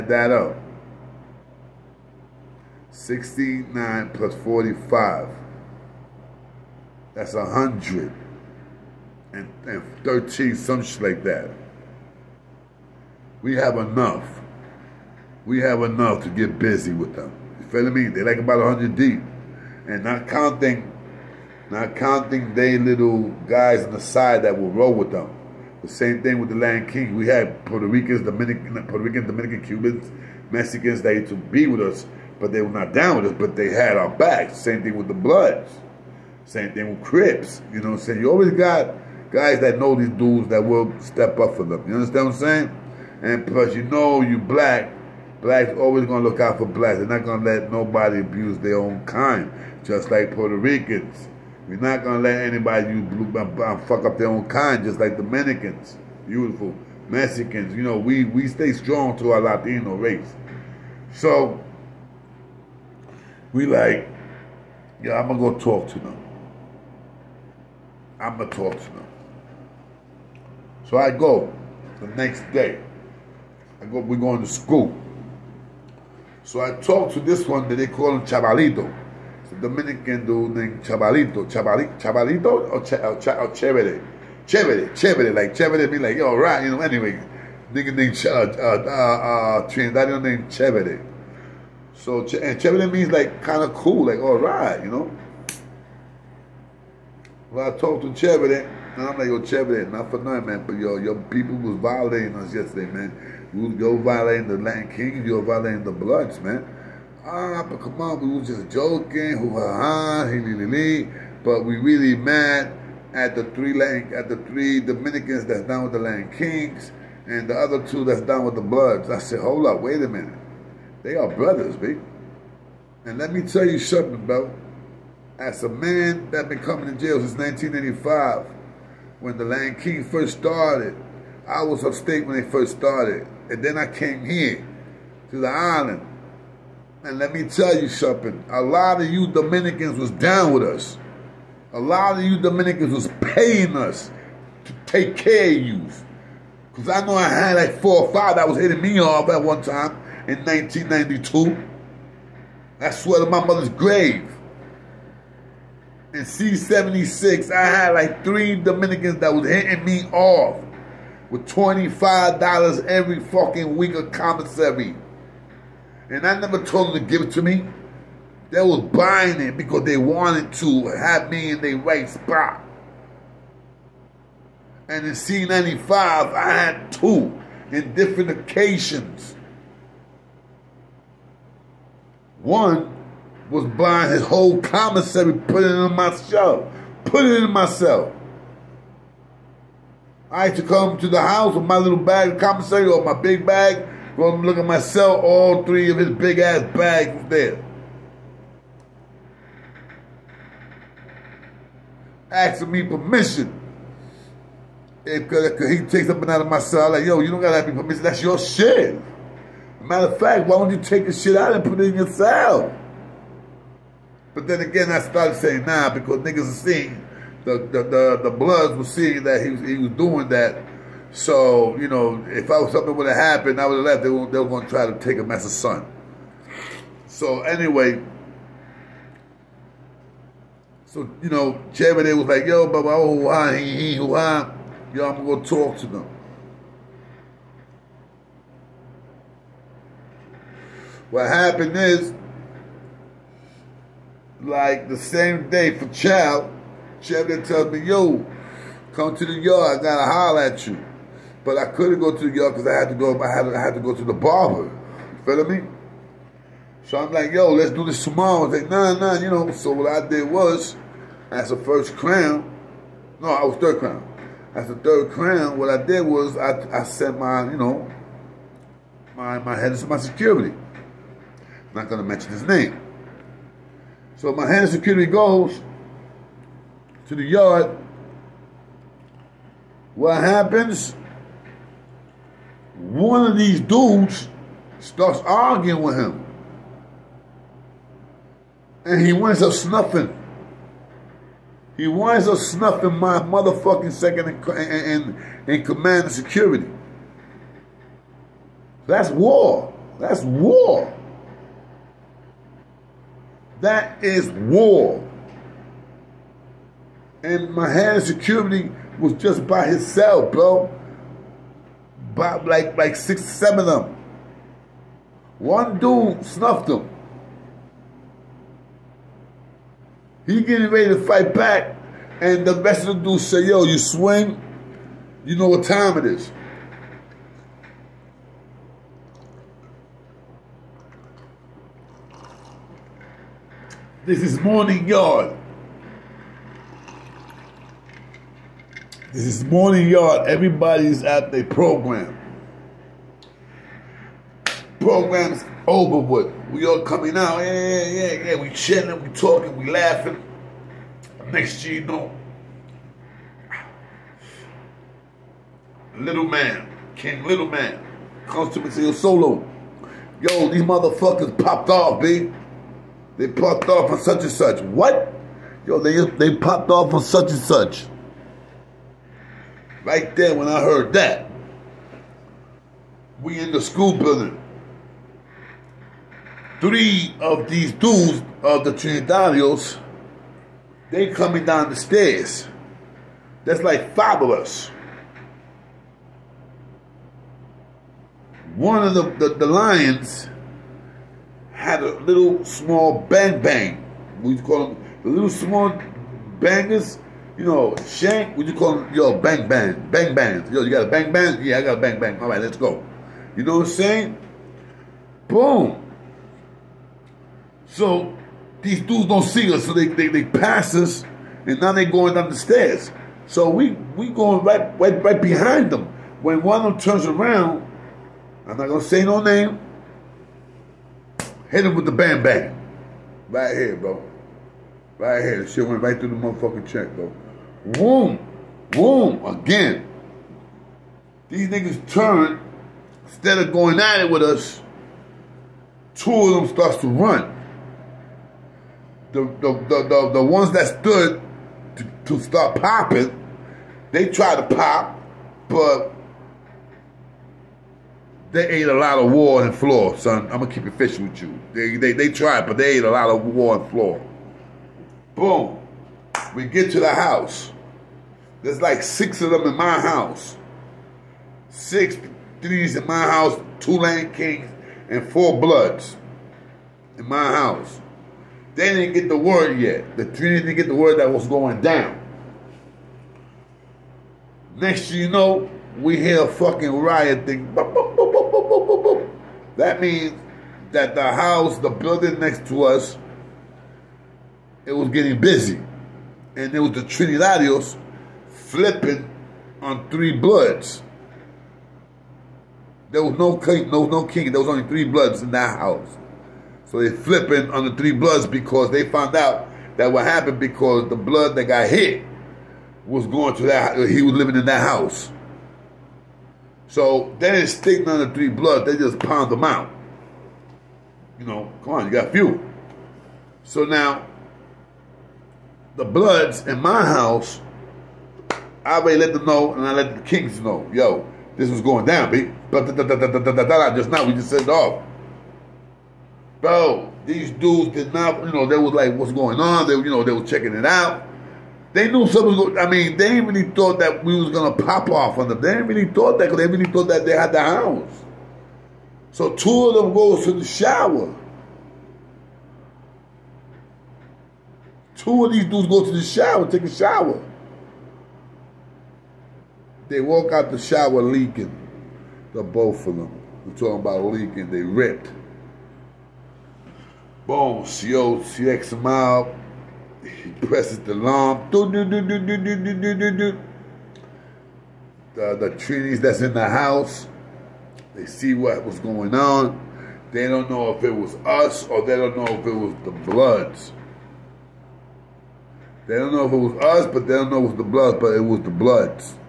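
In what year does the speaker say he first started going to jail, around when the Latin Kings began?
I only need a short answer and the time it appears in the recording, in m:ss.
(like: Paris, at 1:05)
1985, at 2:07.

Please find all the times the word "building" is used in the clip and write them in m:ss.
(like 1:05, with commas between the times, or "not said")
6:13, 8:01.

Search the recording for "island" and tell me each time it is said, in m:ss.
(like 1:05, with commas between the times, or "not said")
2:15.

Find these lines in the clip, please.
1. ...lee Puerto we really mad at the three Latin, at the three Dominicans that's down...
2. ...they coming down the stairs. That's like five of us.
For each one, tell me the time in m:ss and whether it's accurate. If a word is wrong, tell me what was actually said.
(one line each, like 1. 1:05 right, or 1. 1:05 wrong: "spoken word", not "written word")
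1. 1:50 wrong: "But", not "Puerto"
2. 6:20 right.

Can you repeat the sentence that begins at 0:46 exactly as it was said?
They're not going to let nobody abuse their own kind, just like Puerto Ricans.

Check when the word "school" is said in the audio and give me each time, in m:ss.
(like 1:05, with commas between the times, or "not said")
1:14, 6:13.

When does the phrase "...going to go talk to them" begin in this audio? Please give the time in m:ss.
1:05.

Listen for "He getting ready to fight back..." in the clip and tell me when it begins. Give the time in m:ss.
5:20.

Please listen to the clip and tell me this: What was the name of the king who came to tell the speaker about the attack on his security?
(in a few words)
King Little Man.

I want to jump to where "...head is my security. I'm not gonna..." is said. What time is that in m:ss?
4:29.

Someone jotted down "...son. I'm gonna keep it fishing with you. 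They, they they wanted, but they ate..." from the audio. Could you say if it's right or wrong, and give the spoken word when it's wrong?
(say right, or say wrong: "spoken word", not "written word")
wrong: "tried", not "wanted".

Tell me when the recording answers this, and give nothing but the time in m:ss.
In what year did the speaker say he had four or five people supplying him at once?
2:30.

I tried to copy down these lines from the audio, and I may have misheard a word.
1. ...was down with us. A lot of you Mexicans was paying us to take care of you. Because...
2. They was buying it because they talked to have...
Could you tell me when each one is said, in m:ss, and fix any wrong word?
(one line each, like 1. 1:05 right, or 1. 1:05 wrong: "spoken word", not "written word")
1. 2:19 wrong: "Dominicans", not "Mexicans"
2. 2:48 wrong: "wanted", not "talked".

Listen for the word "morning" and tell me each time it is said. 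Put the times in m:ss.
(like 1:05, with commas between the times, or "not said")
5:34, 5:39.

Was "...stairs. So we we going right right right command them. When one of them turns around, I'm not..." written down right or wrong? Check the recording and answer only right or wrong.
wrong.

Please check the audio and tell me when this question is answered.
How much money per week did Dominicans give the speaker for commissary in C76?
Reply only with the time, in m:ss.
2:41.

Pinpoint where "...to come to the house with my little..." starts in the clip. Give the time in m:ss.
3:10.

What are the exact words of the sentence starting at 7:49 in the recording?
The three didn't get the word that was going down.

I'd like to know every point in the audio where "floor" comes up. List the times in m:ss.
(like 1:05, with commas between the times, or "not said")
7:29, 7:33.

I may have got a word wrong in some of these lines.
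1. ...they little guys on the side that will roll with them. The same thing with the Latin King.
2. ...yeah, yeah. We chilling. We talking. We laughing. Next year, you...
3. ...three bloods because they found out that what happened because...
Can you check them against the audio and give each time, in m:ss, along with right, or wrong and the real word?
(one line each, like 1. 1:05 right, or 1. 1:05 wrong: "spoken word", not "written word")
1. 0:22 right
2. 5:47 right
3. 8:17 right.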